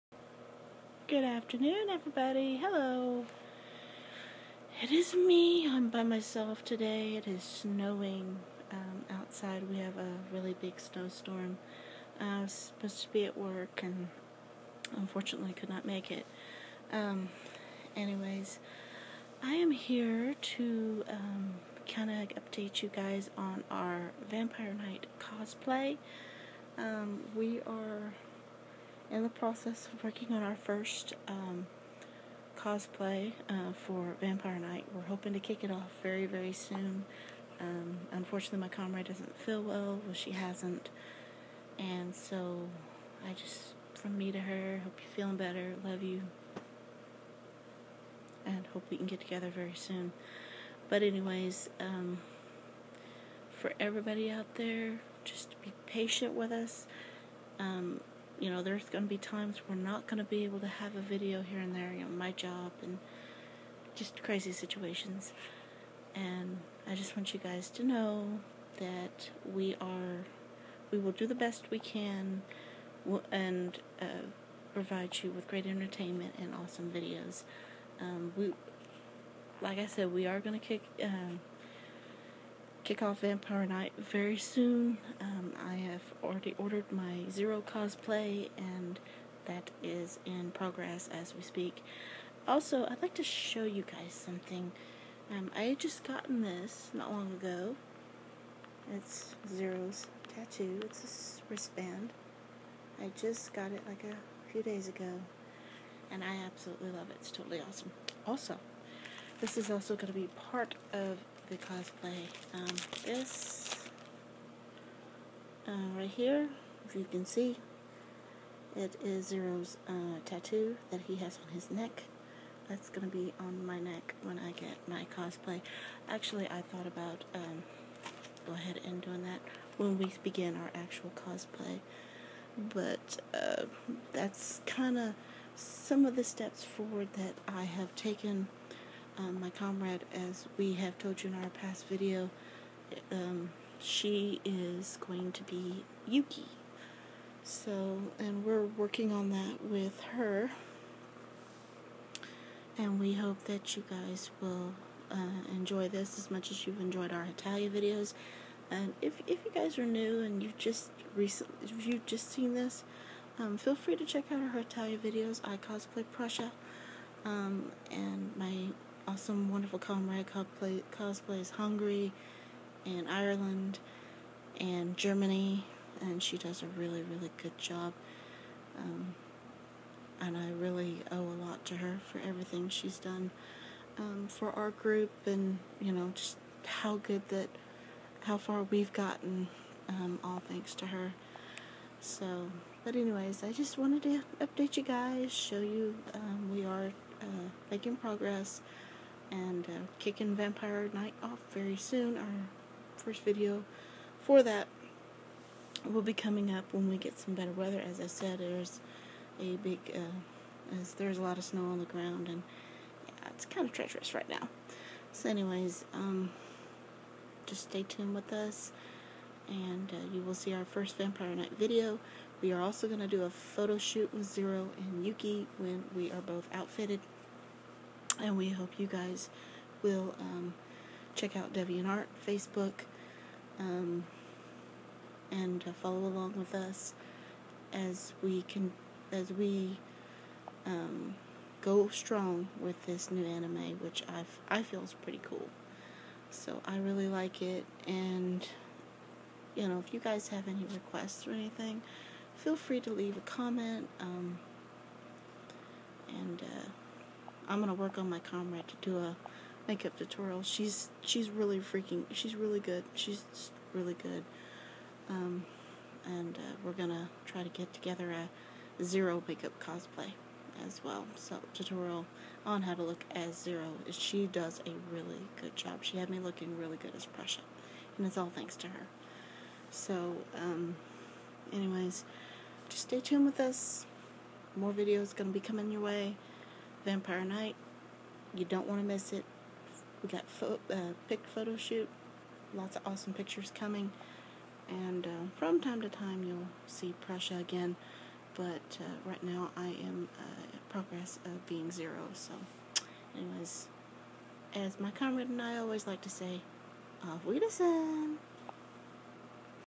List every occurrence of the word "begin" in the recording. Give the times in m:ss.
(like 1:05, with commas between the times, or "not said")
2:10.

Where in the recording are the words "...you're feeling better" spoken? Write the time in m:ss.
0:44.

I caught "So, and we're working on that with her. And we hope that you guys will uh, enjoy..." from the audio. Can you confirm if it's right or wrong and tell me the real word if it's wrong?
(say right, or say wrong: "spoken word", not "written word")
right.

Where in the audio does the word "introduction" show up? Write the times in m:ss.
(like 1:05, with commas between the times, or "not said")
not said.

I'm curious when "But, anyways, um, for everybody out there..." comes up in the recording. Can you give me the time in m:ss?
0:50.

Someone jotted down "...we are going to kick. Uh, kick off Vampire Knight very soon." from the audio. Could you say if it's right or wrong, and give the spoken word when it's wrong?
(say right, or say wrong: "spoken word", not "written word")
right.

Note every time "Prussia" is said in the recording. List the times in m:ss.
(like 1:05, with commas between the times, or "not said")
2:46, 4:37, 4:57.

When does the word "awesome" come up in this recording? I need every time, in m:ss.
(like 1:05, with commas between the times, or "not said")
1:16, 1:47, 2:49, 4:52.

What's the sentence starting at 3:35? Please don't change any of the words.
So, anyways, um, just stay tuned with us, and uh, you will see our first Vampire Knight video.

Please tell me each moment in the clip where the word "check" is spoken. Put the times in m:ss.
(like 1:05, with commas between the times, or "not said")
2:44, 3:51.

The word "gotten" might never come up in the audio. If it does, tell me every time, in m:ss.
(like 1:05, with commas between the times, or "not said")
1:36, 3:08.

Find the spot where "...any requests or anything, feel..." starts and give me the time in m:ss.
4:10.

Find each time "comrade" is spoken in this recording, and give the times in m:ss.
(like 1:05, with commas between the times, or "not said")
0:38, 2:19, 2:49, 4:18, 5:04.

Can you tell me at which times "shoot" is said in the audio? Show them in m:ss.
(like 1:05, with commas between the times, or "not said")
3:43, 4:51.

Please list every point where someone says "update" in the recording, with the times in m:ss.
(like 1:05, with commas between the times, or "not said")
0:22, 3:14.